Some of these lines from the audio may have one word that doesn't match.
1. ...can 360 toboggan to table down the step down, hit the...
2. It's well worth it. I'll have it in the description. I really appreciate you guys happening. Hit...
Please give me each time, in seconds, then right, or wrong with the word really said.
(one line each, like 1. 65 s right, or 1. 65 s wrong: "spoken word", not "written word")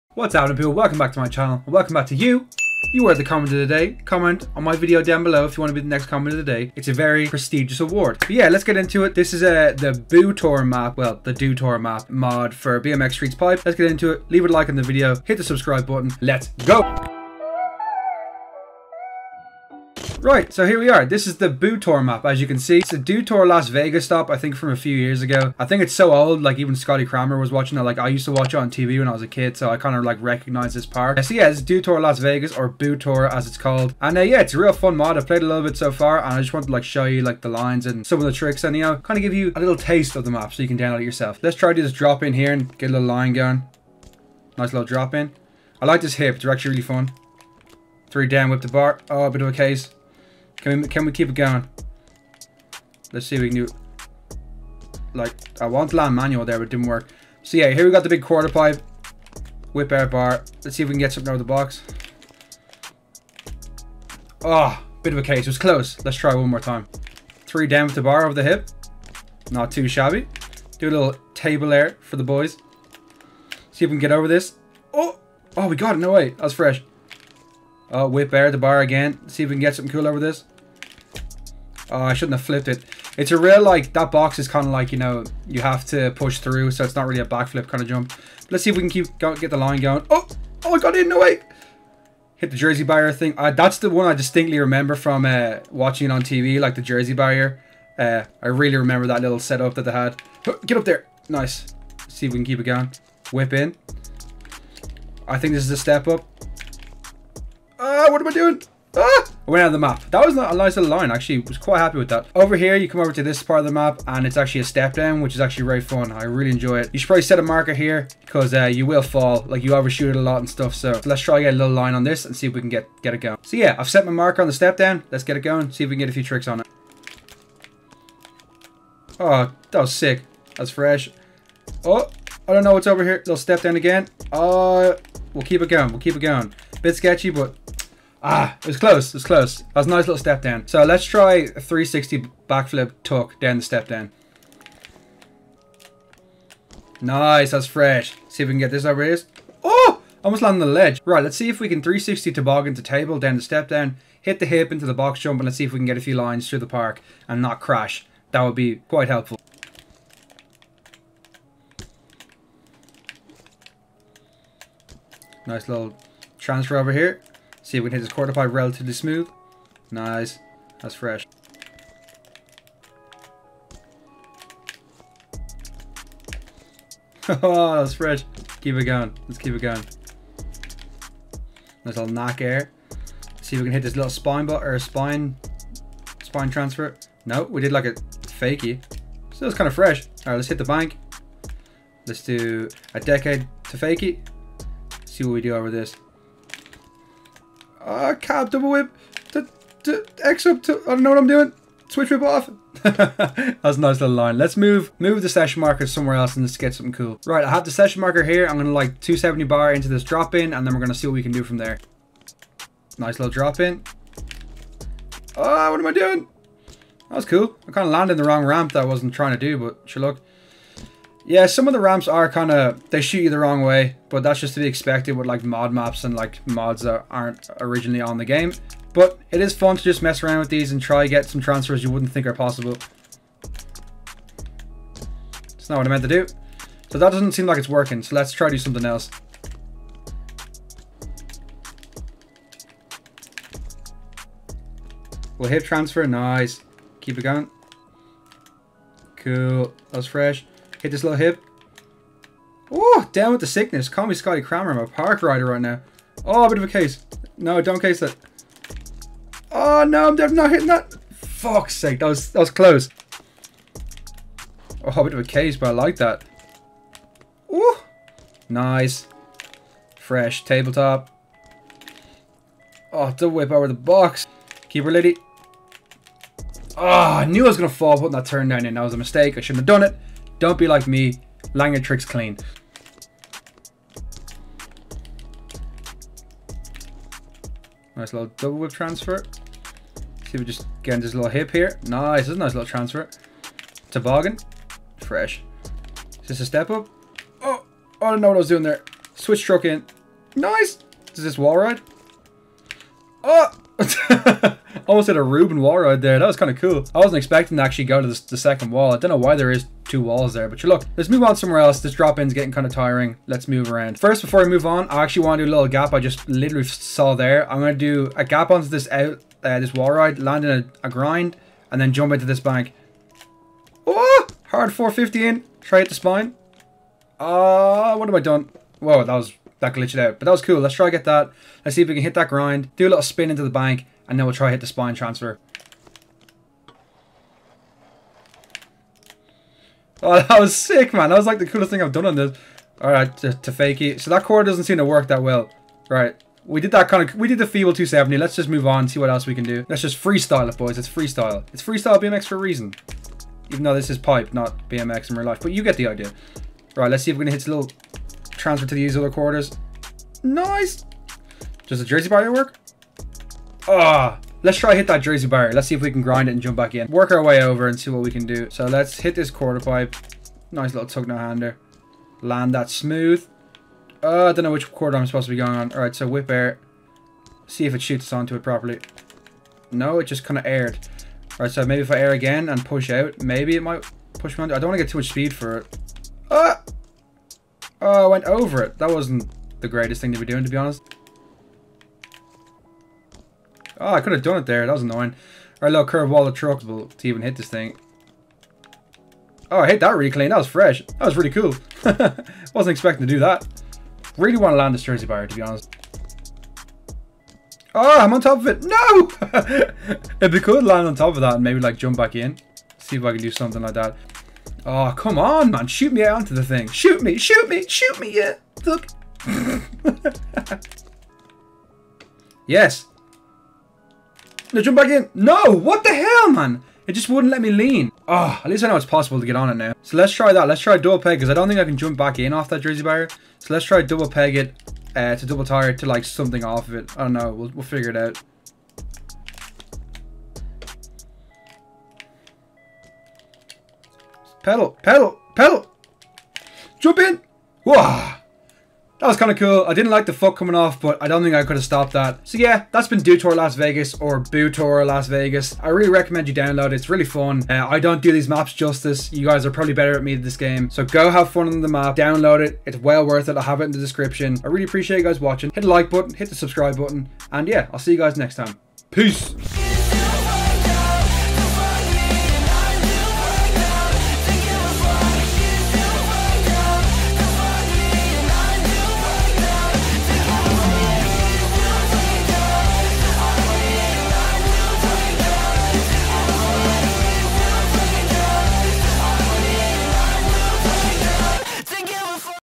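1. 151 s right
2. 462 s wrong: "watching", not "happening".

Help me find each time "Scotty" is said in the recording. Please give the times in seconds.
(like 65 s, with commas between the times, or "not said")
26 s, 254 s.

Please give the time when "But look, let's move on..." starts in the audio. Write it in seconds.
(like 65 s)
310 s.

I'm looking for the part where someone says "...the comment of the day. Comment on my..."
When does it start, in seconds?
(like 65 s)
3 s.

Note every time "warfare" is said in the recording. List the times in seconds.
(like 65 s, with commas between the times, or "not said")
not said.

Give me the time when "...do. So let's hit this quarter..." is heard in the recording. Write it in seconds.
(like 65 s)
368 s.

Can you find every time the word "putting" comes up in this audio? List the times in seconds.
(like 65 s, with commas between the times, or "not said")
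277 s.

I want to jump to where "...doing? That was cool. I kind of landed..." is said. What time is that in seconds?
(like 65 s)
215 s.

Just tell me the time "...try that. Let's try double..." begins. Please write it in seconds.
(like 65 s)
430 s.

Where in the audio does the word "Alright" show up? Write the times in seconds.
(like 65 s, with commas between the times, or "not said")
342 s.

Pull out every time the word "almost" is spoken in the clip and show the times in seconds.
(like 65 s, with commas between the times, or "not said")
150 s, 304 s.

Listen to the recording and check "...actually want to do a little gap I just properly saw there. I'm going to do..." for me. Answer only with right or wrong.
wrong.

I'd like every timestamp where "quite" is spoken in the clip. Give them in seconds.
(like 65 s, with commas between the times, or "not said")
111 s, 158 s.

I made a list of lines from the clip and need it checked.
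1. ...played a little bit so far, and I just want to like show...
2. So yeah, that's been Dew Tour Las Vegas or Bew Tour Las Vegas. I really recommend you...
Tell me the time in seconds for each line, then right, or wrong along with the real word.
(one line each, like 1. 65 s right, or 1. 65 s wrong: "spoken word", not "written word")
1. 35 s right
2. 452 s right.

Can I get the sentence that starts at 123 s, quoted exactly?
So yeah, I've set my marker on the step down.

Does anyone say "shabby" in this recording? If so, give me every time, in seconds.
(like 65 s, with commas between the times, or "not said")
69 s.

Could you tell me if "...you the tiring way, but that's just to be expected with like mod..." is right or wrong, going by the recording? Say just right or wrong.
wrong.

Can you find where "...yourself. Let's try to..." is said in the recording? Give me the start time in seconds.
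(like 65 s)
41 s.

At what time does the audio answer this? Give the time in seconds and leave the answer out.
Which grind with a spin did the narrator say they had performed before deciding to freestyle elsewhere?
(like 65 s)
347 s.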